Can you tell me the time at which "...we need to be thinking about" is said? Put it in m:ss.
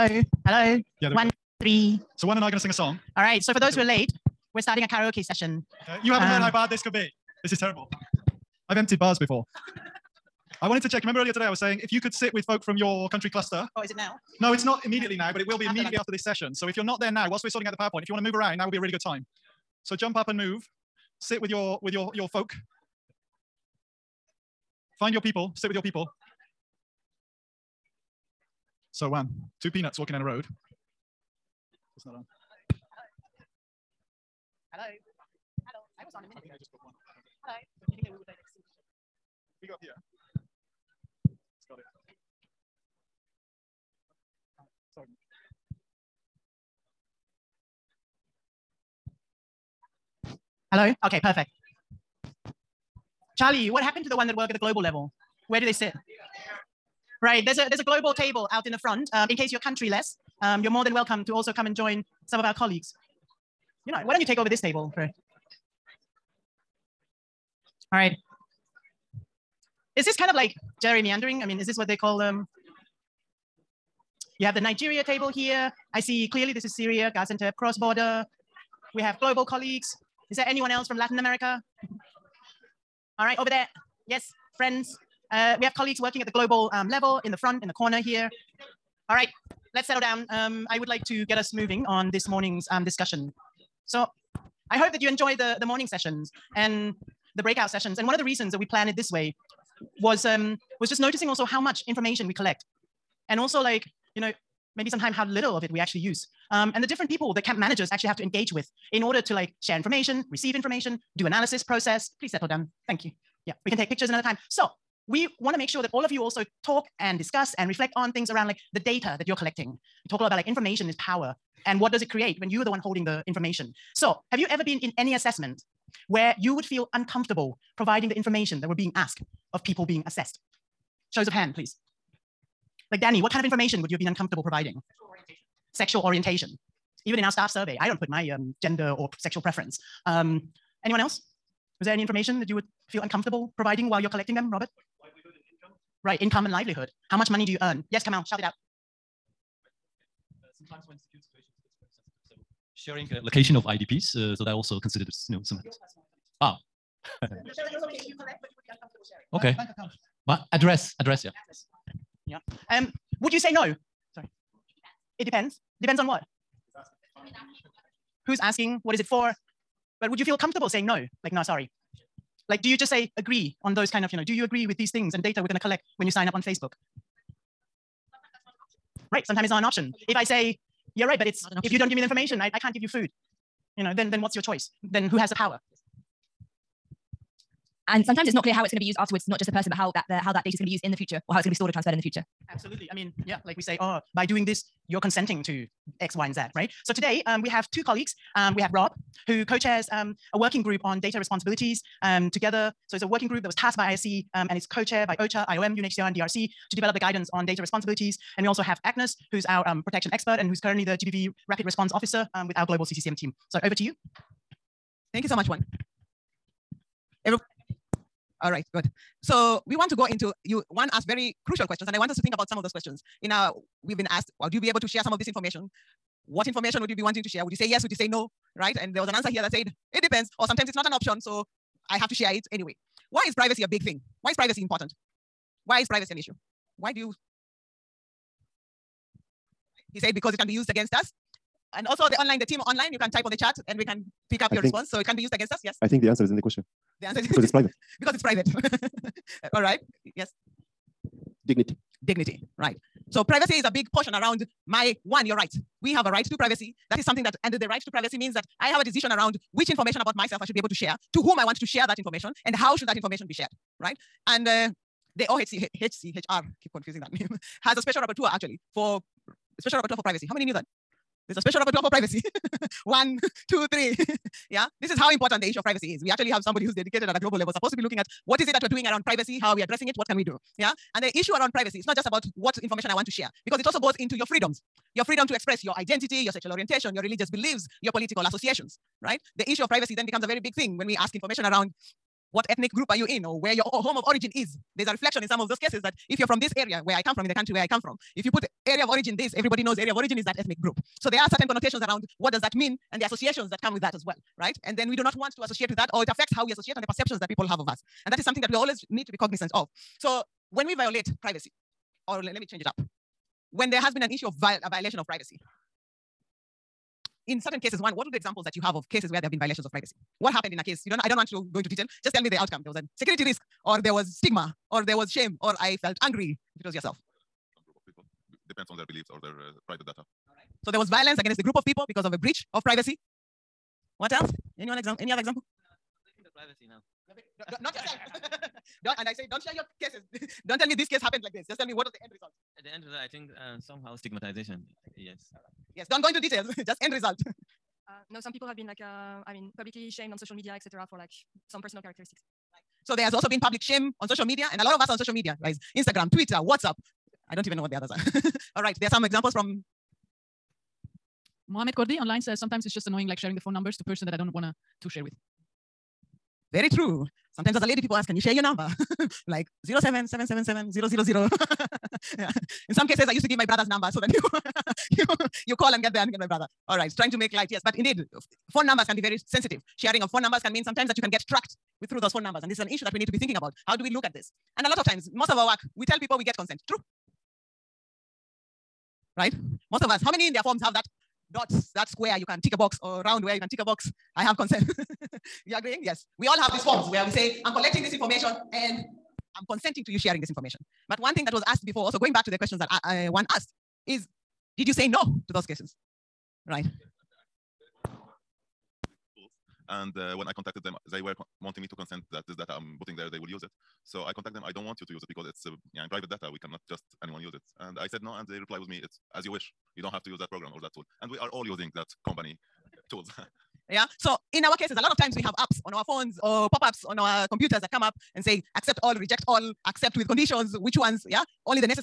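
6:22.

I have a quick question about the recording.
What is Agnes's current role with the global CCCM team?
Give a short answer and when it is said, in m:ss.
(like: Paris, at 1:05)
GBV Rapid Response Officer, at 3:30.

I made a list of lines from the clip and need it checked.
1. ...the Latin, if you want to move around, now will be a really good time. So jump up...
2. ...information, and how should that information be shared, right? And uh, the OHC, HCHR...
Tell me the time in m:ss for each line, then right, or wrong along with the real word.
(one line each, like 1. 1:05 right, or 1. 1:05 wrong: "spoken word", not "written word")
1. 0:17 wrong: "PowerPoint", not "Latin"
2. 4:21 right.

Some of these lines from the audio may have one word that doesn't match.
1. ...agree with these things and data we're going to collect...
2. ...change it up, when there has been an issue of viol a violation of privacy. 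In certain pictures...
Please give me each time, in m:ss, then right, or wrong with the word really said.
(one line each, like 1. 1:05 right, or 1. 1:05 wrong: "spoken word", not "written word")
1. 2:54 right
2. 5:12 wrong: "cases", not "pictures".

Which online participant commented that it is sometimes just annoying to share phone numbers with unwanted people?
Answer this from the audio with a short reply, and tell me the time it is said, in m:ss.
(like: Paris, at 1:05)
Mohamed Kordi, at 6:01.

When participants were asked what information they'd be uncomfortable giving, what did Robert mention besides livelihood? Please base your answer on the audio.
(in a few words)
Income.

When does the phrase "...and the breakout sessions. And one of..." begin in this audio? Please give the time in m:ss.
1:36.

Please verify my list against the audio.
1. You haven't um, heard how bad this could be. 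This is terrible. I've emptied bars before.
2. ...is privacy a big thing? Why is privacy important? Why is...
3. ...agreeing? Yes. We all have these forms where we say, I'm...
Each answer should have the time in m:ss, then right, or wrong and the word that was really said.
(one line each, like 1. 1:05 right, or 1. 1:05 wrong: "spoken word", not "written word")
1. 0:06 right
2. 3:53 right
3. 6:35 right.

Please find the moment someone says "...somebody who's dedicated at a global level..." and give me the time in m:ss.
4:36.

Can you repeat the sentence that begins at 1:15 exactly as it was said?
I see clearly this is Syria, Gaziantep, cross-border.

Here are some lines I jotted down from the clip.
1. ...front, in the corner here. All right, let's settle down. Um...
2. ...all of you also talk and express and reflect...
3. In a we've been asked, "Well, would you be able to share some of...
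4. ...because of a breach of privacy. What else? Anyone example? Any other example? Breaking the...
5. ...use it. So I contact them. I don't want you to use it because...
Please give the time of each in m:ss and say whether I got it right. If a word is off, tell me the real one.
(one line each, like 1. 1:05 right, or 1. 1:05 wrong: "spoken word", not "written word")
1. 1:27 right
2. 1:55 wrong: "discuss", not "express"
3. 3:43 right
4. 5:31 right
5. 6:53 right.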